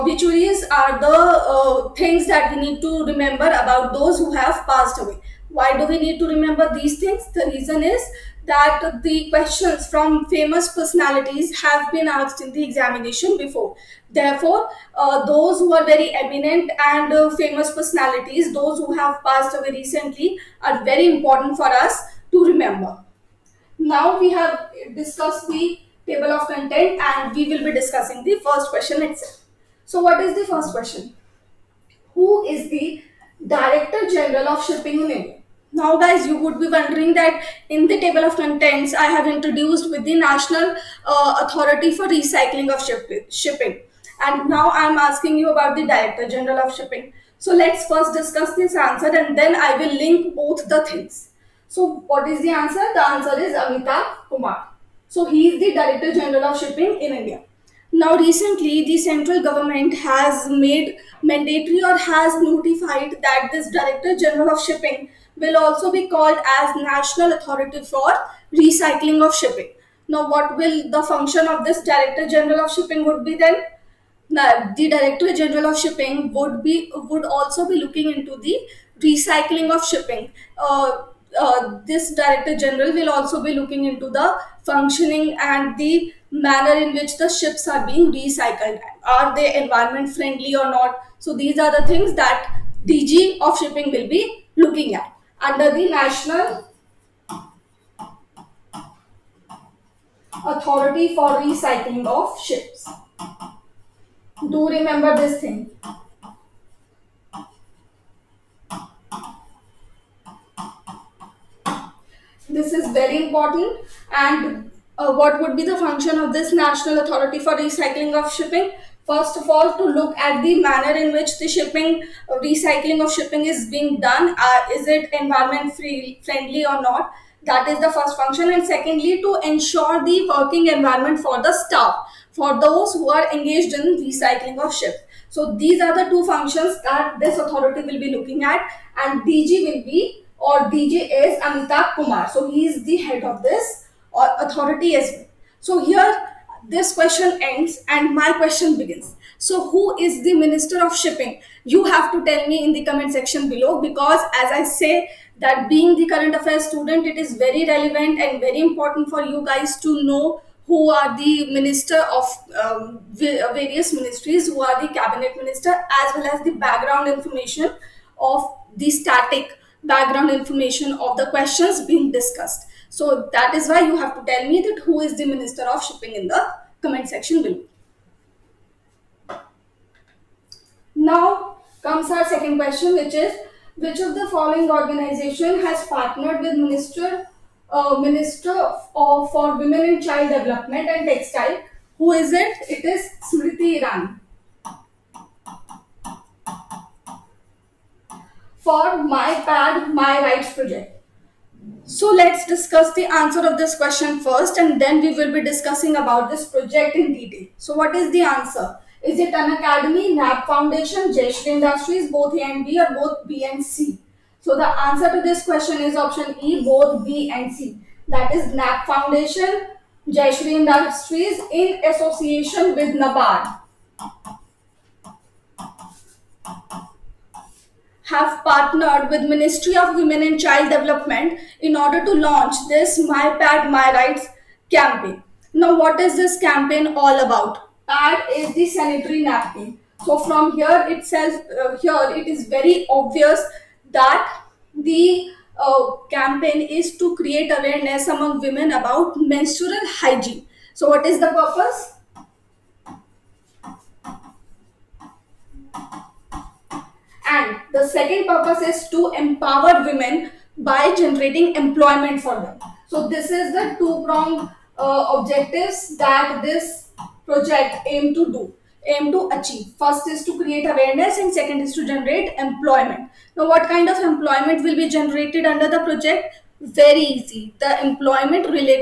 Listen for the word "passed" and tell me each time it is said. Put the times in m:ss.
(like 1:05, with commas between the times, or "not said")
0:04, 0:19.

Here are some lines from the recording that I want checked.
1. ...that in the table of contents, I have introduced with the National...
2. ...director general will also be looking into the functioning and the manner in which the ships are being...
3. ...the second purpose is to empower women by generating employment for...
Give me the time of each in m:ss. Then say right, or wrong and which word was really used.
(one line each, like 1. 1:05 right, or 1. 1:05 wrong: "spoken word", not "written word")
1. 0:37 right
2. 1:22 right
3. 4:17 right.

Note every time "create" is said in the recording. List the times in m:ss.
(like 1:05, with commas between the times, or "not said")
4:07, 4:30.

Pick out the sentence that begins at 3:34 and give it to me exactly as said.
So the answer to this question is option E, both B and C.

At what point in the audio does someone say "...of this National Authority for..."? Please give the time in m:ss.
1:56.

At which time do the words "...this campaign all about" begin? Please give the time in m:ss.
3:56.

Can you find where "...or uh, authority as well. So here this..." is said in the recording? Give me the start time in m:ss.
2:24.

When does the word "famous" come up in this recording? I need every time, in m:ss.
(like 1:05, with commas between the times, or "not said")
0:10, 0:17.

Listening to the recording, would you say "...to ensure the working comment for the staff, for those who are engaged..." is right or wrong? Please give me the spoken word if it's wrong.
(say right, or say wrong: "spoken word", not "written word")
wrong: "environment", not "comment".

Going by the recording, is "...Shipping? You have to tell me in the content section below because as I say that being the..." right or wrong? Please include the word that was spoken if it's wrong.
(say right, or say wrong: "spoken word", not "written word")
wrong: "comment", not "content".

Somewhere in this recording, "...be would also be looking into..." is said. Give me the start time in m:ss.
1:16.